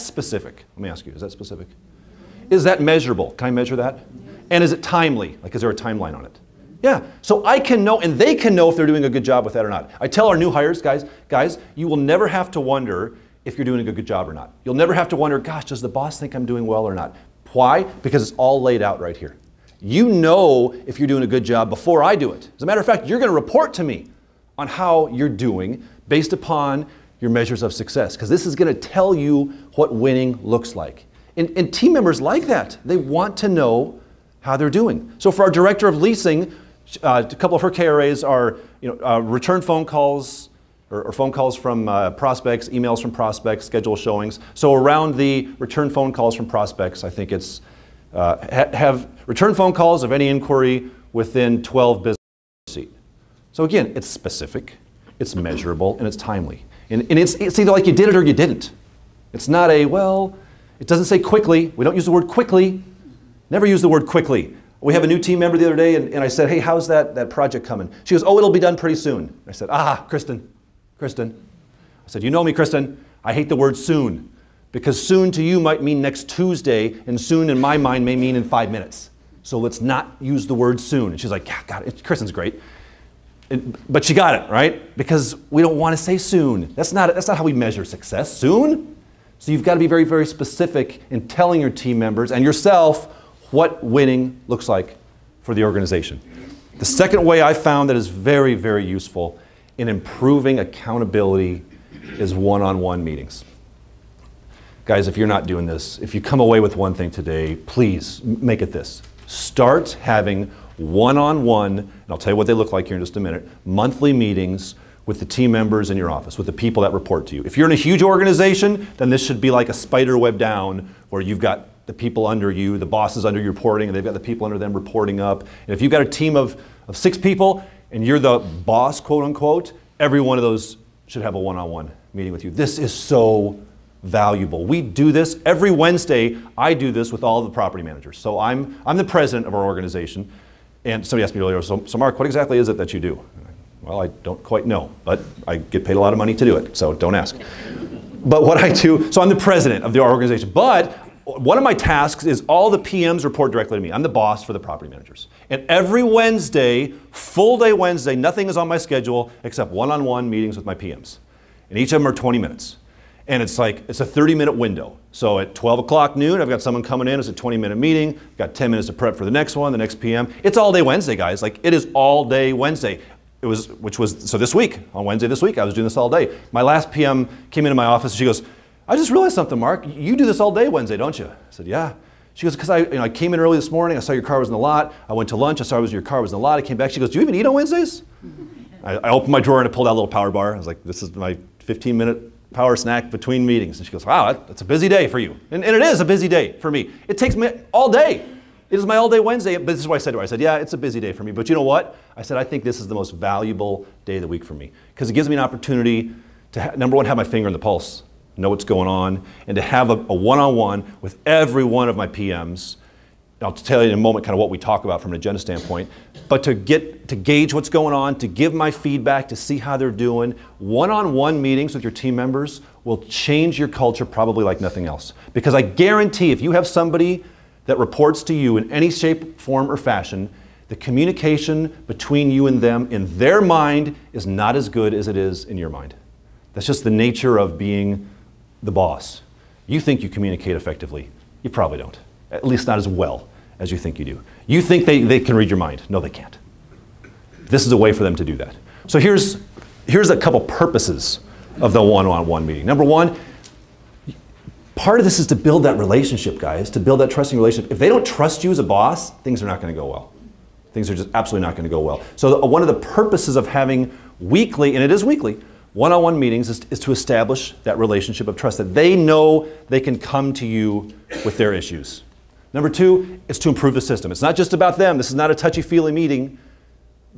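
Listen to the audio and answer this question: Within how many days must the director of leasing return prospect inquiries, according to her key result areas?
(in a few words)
12 business.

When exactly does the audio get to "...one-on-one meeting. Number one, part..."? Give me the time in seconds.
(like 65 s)
251 s.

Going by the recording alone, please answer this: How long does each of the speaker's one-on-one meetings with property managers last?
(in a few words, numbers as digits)
20 minutes.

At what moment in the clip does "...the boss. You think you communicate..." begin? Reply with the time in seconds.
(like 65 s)
238 s.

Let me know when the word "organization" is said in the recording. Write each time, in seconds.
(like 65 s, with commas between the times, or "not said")
95 s, 118 s, 139 s, 149 s.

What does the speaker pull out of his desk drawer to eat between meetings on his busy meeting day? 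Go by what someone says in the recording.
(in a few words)
power bar.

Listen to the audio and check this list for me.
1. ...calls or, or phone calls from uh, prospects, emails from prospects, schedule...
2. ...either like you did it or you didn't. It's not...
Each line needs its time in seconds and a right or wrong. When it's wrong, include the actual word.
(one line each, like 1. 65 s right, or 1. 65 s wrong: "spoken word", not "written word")
1. 39 s right
2. 57 s right.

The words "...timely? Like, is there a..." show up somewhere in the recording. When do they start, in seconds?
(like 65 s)
4 s.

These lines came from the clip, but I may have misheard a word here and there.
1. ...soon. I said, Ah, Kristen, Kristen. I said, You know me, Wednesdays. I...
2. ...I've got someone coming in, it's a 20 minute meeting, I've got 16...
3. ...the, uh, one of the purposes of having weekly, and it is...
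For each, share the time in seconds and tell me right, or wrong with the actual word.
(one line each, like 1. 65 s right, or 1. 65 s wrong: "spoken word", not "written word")
1. 68 s wrong: "Kristen", not "Wednesdays"
2. 166 s wrong: "10", not "16"
3. 262 s right.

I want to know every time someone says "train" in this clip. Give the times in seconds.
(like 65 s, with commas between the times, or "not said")
not said.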